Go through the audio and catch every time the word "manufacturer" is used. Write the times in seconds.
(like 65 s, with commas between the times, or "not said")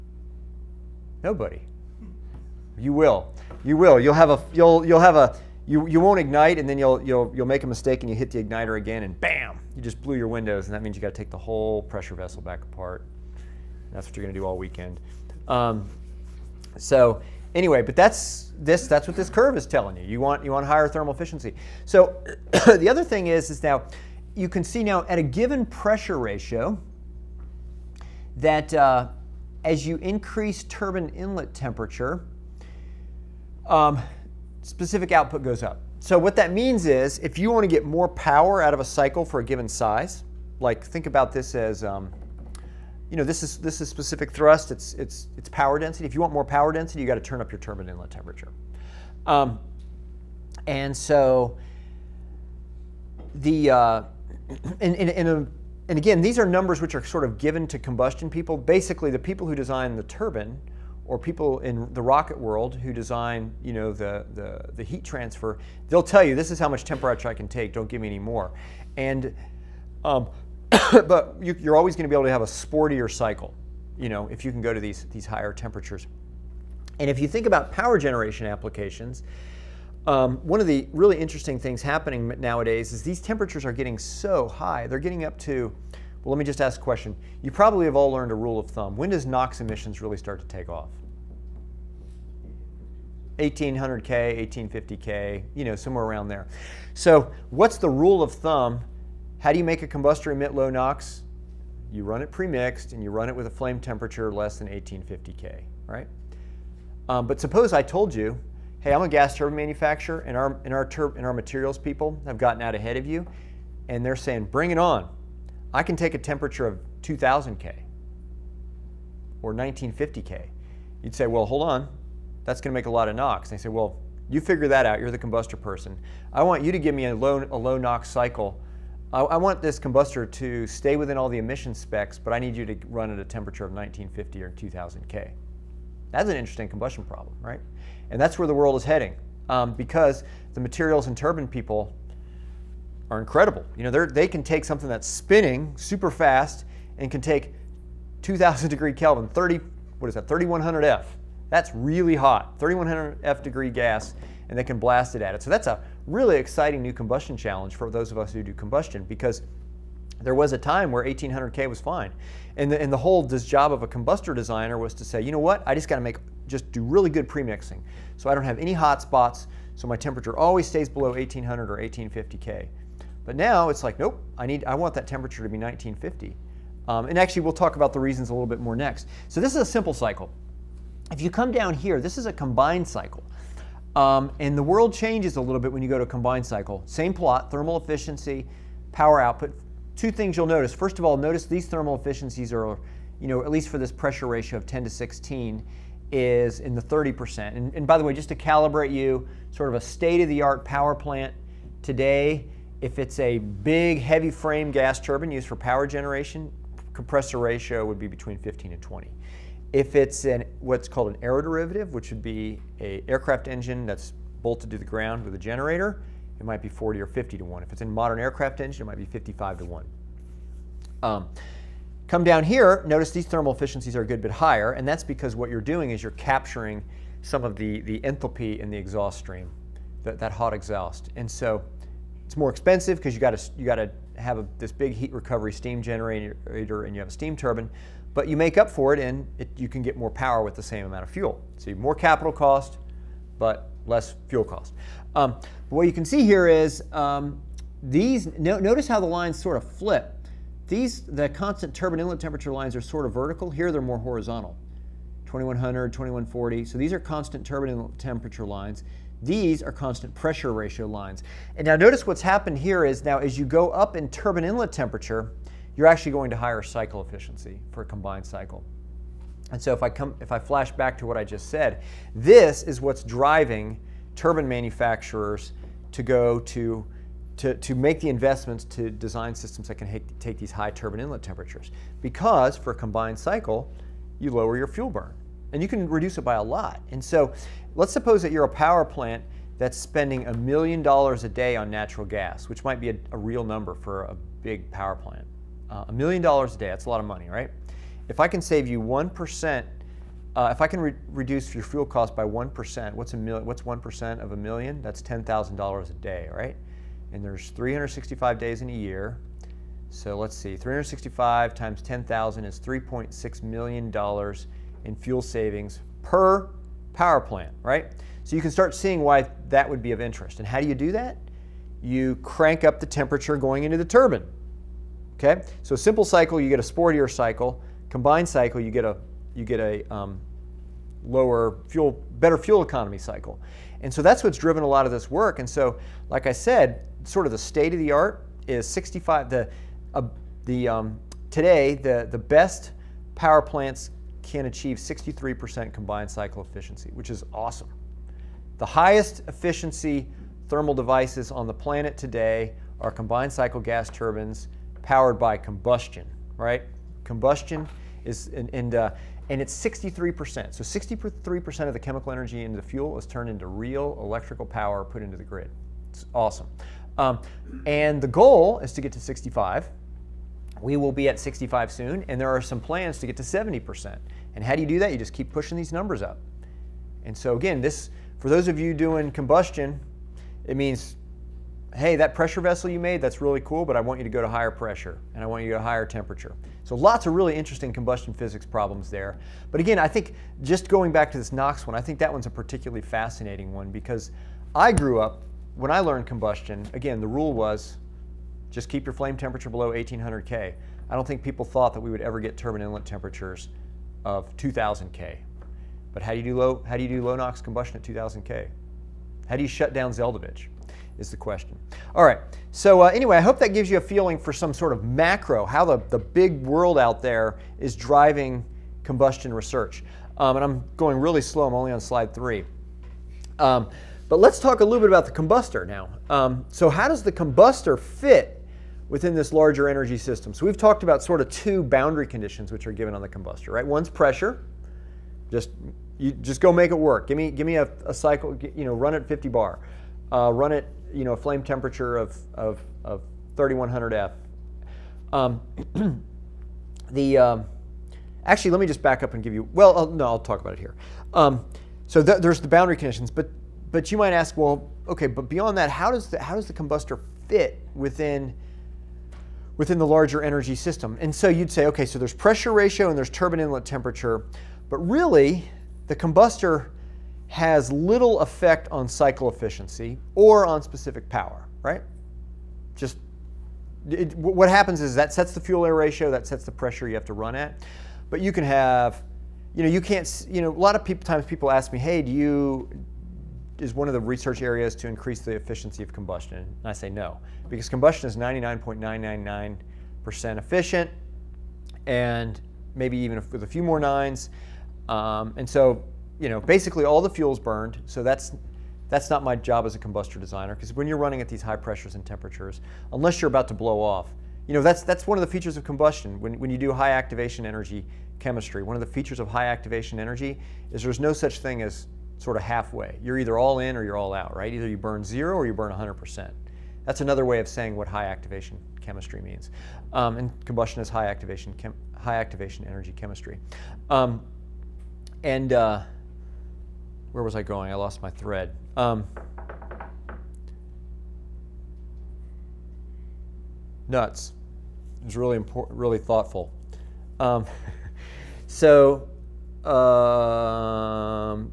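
109 s, 274 s.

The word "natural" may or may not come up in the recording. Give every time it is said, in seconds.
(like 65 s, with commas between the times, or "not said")
291 s.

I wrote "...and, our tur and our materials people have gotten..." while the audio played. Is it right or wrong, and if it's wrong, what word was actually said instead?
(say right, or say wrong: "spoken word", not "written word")
right.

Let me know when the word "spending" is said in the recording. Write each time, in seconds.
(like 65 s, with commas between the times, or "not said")
289 s.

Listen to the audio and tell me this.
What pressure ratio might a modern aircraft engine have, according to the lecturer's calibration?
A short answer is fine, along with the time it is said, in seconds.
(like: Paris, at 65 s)
55 to 1, at 219 s.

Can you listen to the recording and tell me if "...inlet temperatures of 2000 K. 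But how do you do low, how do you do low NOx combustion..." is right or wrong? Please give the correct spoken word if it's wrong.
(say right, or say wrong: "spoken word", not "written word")
right.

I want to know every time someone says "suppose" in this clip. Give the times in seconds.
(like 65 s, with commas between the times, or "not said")
107 s, 287 s.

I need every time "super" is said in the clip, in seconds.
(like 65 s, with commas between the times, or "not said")
145 s.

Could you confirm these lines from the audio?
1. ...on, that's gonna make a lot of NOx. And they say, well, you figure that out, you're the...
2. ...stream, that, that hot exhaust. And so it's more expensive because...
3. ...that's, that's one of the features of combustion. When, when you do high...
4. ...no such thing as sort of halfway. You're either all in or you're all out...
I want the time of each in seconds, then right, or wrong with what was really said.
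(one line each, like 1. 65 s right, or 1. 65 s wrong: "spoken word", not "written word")
1. 121 s right
2. 229 s right
3. 504 s right
4. 510 s right.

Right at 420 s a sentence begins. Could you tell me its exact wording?
Um, and I'm going really slow, I'm only on slide three.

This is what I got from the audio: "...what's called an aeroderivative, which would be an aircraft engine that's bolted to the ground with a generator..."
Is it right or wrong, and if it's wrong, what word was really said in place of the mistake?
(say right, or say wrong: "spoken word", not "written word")
right.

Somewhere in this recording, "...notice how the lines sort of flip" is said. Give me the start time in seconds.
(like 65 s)
248 s.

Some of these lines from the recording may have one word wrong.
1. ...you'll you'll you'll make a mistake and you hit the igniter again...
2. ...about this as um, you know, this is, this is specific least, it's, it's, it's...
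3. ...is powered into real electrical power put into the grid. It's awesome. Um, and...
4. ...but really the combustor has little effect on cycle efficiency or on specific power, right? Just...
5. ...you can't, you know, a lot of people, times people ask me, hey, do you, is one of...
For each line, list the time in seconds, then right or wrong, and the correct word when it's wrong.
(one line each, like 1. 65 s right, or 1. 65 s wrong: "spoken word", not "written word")
1. 6 s right
2. 41 s wrong: "thrust", not "least"
3. 362 s wrong: "turned", not "powered"
4. 464 s right
5. 479 s right.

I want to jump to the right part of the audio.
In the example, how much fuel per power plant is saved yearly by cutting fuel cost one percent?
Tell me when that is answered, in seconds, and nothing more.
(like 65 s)
312 s.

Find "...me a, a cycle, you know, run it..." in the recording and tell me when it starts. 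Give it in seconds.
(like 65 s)
437 s.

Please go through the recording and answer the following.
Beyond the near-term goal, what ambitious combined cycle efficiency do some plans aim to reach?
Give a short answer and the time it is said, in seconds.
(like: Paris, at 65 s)
70%, at 373 s.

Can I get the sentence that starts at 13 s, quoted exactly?
That's what you're going to do all weekend.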